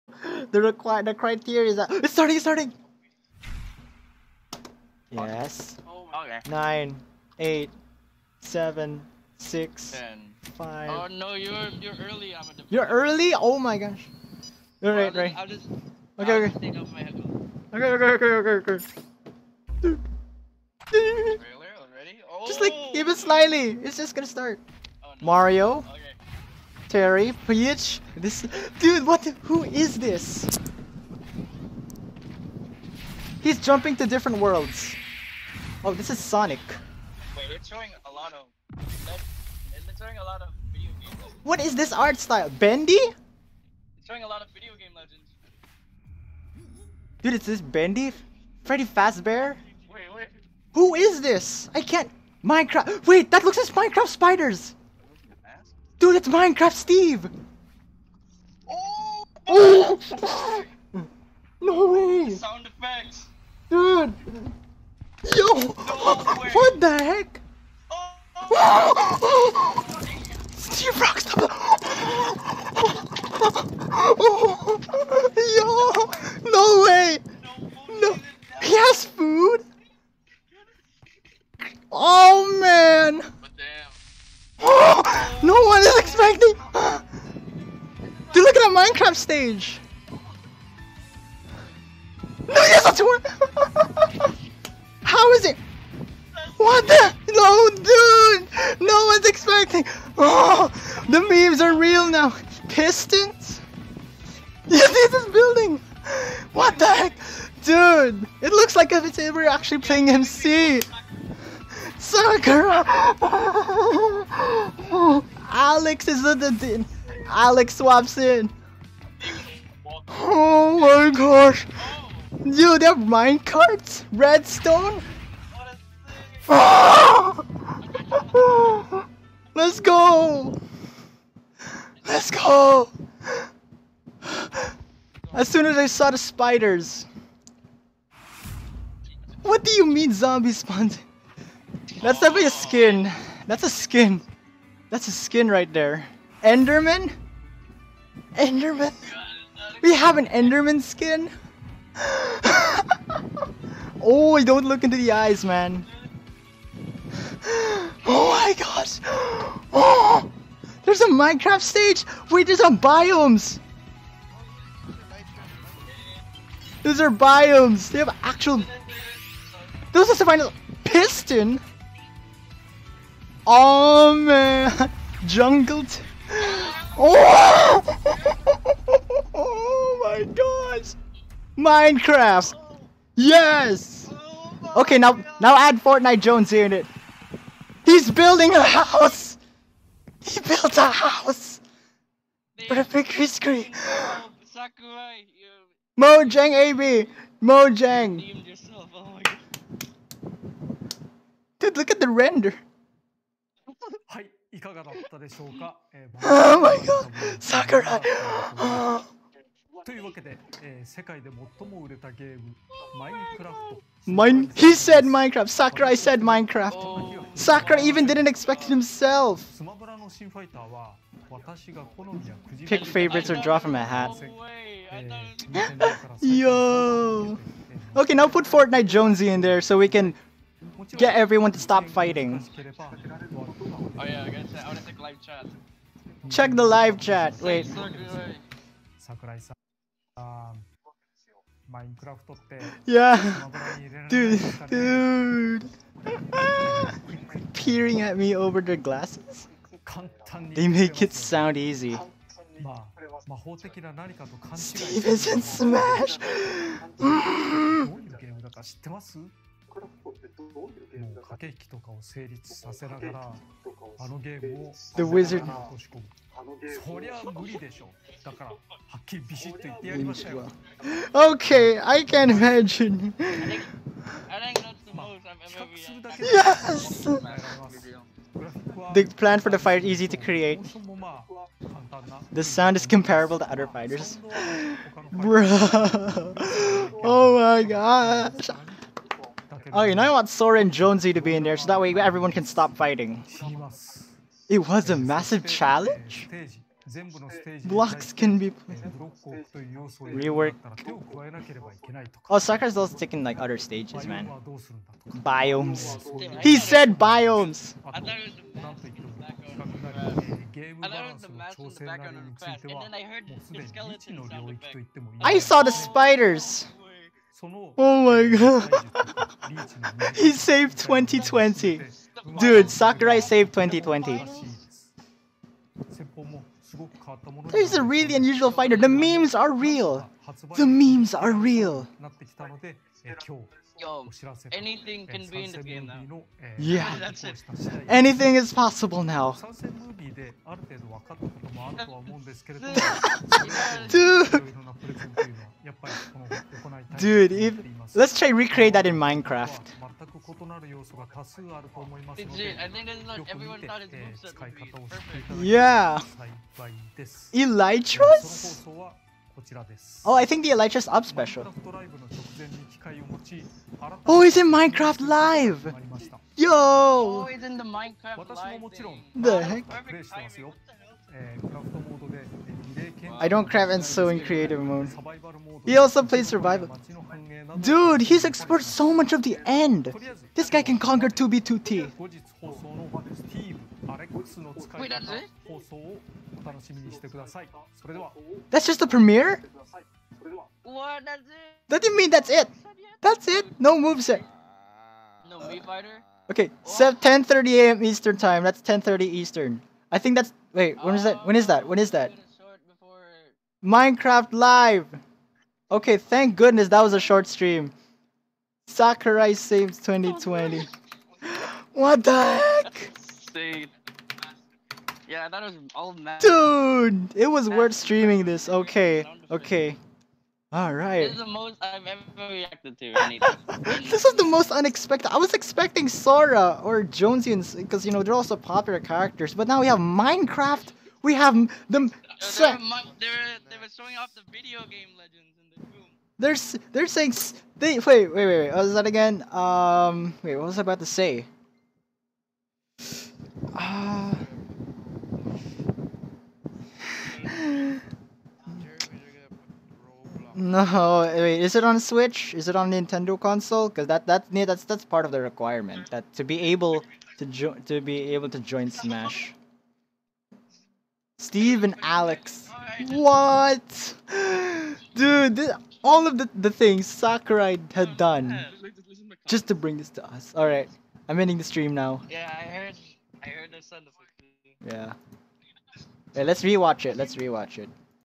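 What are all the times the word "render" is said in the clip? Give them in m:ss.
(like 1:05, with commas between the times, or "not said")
3:22.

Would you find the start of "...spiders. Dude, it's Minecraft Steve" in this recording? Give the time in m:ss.
0:54.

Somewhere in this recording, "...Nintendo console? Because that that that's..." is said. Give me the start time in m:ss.
7:32.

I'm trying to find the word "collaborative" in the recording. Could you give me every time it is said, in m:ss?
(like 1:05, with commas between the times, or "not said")
not said.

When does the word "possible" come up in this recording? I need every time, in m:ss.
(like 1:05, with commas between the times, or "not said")
5:38.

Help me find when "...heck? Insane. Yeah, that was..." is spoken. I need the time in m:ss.
6:52.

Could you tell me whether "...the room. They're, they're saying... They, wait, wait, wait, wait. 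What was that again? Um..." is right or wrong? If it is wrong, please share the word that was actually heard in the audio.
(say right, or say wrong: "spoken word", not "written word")
right.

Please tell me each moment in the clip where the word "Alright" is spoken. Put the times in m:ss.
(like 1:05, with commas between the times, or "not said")
7:00, 7:50.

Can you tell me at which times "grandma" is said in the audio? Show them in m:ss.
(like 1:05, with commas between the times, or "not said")
not said.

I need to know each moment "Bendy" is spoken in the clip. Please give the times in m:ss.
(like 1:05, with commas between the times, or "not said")
0:42, 0:47.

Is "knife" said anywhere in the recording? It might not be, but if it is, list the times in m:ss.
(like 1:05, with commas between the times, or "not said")
not said.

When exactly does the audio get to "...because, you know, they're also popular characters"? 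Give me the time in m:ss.
7:07.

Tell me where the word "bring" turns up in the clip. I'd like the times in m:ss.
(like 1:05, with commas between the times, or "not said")
7:49.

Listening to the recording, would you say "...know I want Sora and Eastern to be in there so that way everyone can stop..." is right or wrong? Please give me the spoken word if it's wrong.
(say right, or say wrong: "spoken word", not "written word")
wrong: "Jonesy", not "Eastern".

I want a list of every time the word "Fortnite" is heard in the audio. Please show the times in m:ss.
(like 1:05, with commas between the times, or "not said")
3:05, 3:48.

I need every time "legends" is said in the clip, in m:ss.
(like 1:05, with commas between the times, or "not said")
0:44, 7:14.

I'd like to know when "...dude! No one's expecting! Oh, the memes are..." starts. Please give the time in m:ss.
1:37.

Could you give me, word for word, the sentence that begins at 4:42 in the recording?
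The sound is comparable to other fighters.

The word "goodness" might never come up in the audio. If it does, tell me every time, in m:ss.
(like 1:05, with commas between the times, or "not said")
6:46.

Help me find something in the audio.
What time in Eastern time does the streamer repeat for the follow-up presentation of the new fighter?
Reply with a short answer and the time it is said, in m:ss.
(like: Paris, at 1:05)
10:30 a.m., at 6:36.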